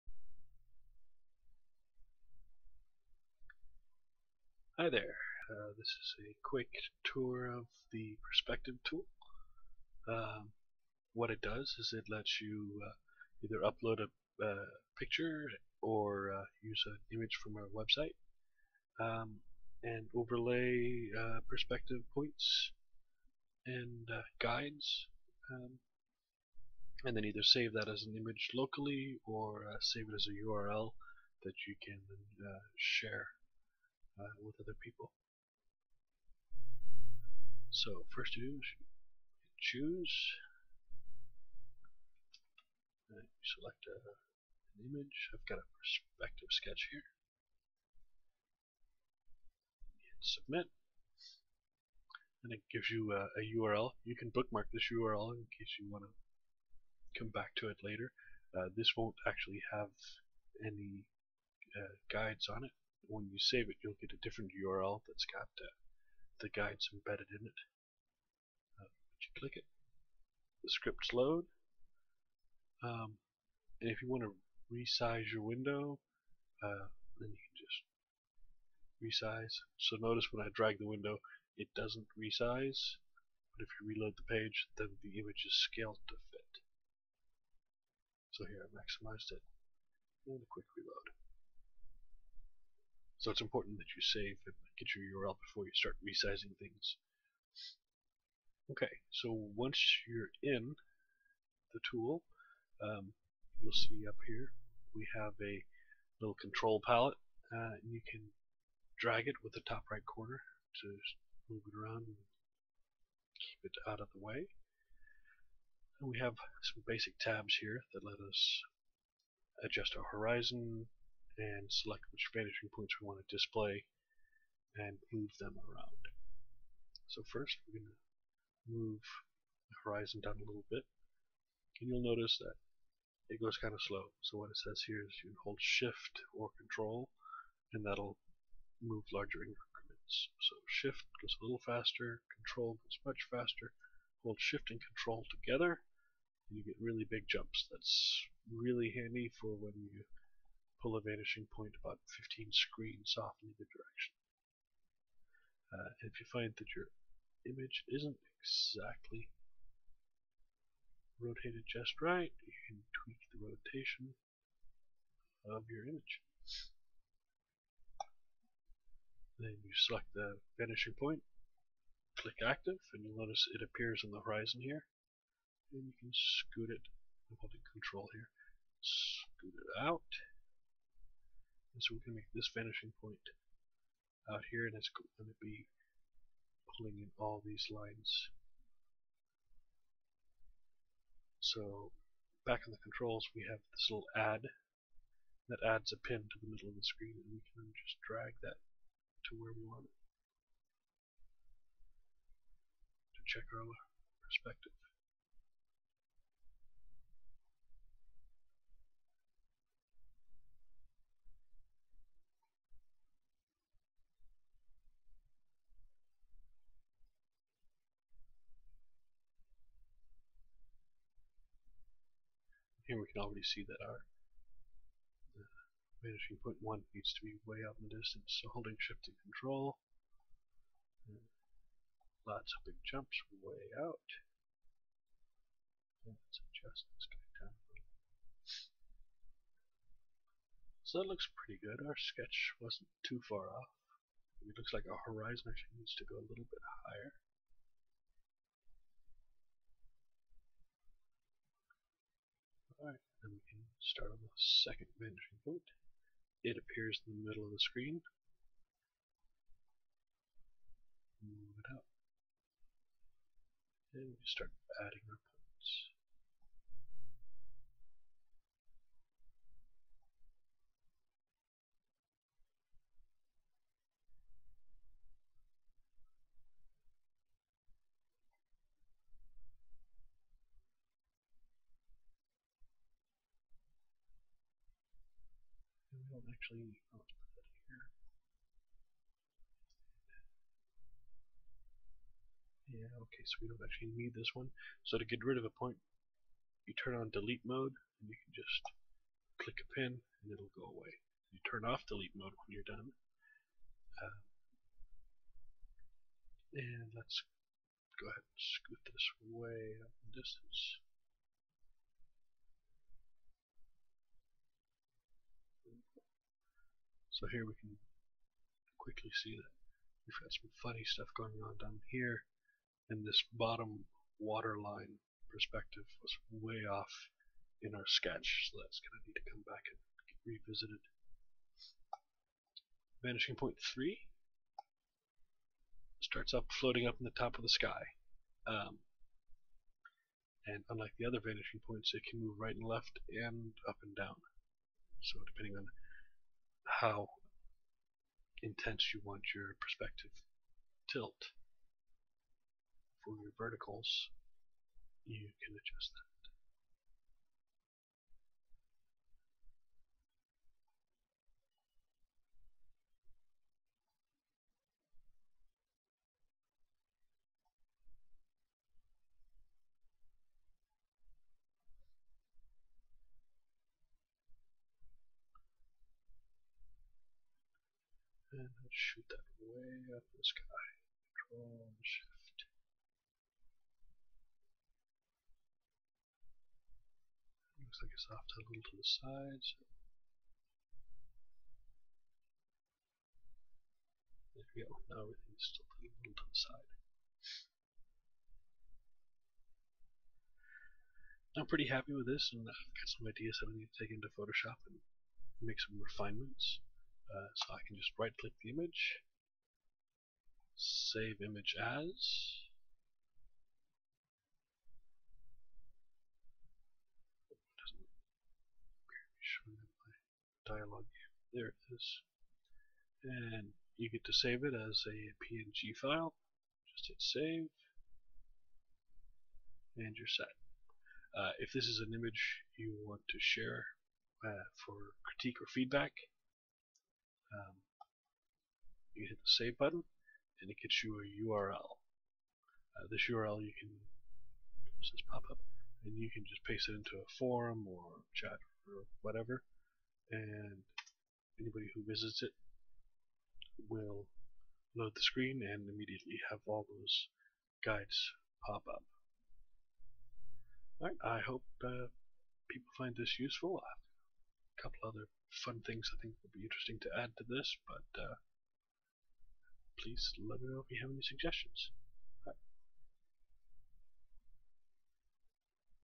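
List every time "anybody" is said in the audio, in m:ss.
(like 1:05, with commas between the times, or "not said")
7:31.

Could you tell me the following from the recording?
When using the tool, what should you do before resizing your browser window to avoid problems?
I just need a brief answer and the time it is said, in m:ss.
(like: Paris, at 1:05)
Save and get your URL, at 1:34.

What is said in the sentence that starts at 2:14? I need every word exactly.
So what it says here is you hold shift or control and that'll move larger increments.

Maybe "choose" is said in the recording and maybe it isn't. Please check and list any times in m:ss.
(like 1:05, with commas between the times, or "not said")
0:39.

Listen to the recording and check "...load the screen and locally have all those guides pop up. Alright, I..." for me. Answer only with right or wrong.
wrong.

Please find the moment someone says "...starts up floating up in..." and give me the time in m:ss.
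5:36.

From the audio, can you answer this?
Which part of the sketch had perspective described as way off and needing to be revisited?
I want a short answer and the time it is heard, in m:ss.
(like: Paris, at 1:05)
Bottom waterline, at 5:23.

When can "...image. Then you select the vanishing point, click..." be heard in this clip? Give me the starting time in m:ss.
2:45.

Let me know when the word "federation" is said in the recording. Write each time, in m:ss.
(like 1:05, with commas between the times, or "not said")
not said.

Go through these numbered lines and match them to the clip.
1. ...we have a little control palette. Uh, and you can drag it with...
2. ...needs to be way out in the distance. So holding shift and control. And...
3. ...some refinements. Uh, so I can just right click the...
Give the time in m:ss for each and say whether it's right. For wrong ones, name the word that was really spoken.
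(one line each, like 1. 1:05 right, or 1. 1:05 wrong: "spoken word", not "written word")
1. 1:44 right
2. 3:46 right
3. 6:45 right.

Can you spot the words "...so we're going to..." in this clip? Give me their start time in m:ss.
3:01.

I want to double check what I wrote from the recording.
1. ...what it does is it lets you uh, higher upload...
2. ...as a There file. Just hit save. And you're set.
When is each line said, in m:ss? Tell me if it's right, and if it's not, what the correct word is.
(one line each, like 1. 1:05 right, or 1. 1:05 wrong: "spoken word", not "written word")
1. 0:11 wrong: "either", not "higher"
2. 7:04 wrong: "PNG", not "There".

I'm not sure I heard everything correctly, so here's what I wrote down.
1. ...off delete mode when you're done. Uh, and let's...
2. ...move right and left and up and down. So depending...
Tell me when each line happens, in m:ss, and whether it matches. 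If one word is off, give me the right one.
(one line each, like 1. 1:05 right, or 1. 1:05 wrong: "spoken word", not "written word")
1. 5:01 right
2. 5:42 right.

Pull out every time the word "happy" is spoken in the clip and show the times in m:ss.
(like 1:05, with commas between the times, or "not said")
6:41.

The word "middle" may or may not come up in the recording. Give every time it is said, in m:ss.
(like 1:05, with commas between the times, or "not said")
3:16, 4:17.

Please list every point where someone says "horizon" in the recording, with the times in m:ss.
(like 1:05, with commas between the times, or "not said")
2:00, 2:09, 2:54, 4:05.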